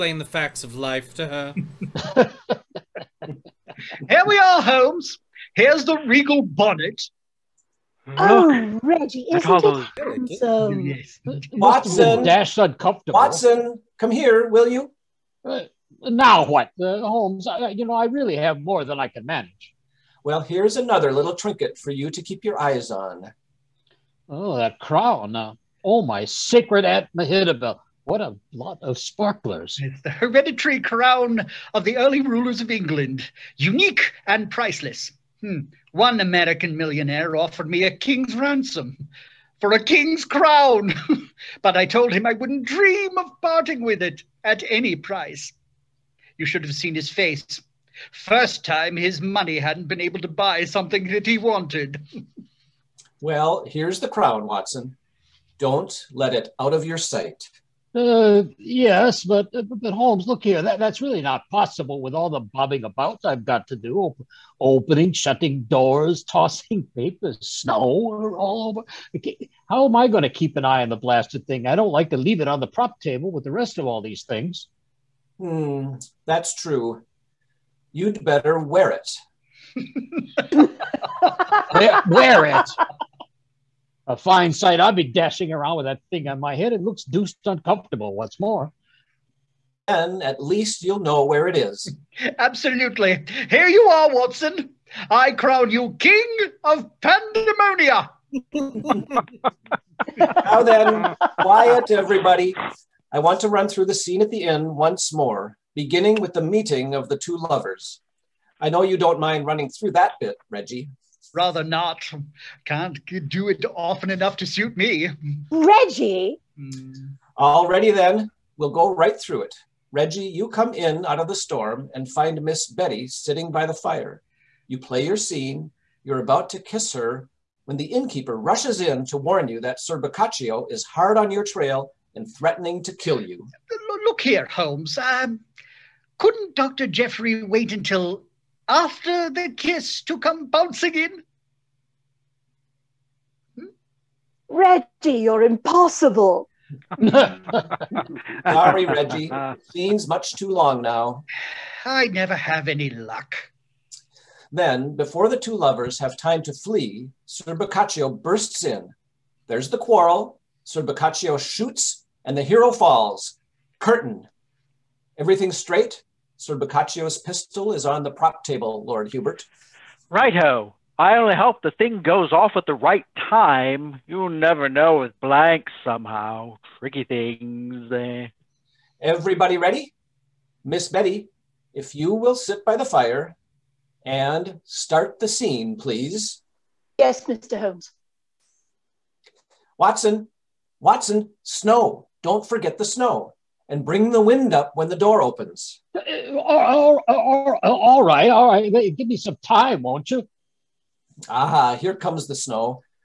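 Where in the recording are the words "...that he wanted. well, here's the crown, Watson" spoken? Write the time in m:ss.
0:51.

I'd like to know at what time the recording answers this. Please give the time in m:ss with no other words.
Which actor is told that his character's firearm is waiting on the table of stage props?
2:48.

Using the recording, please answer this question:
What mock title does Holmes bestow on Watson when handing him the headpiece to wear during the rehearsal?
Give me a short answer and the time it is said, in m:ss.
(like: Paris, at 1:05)
King of Pandemonia, at 1:35.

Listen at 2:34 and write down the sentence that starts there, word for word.
Then, before the two lovers have time to flee, Sir Boccaccio bursts in.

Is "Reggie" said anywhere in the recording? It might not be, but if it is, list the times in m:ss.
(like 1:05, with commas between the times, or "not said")
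0:08, 1:50, 1:55, 1:59, 2:24, 2:28.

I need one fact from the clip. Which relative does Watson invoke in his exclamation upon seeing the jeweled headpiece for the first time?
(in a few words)
Aunt Mehitabel.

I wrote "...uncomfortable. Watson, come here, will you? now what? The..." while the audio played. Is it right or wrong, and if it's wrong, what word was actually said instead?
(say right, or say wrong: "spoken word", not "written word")
right.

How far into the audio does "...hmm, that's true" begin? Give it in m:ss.
1:15.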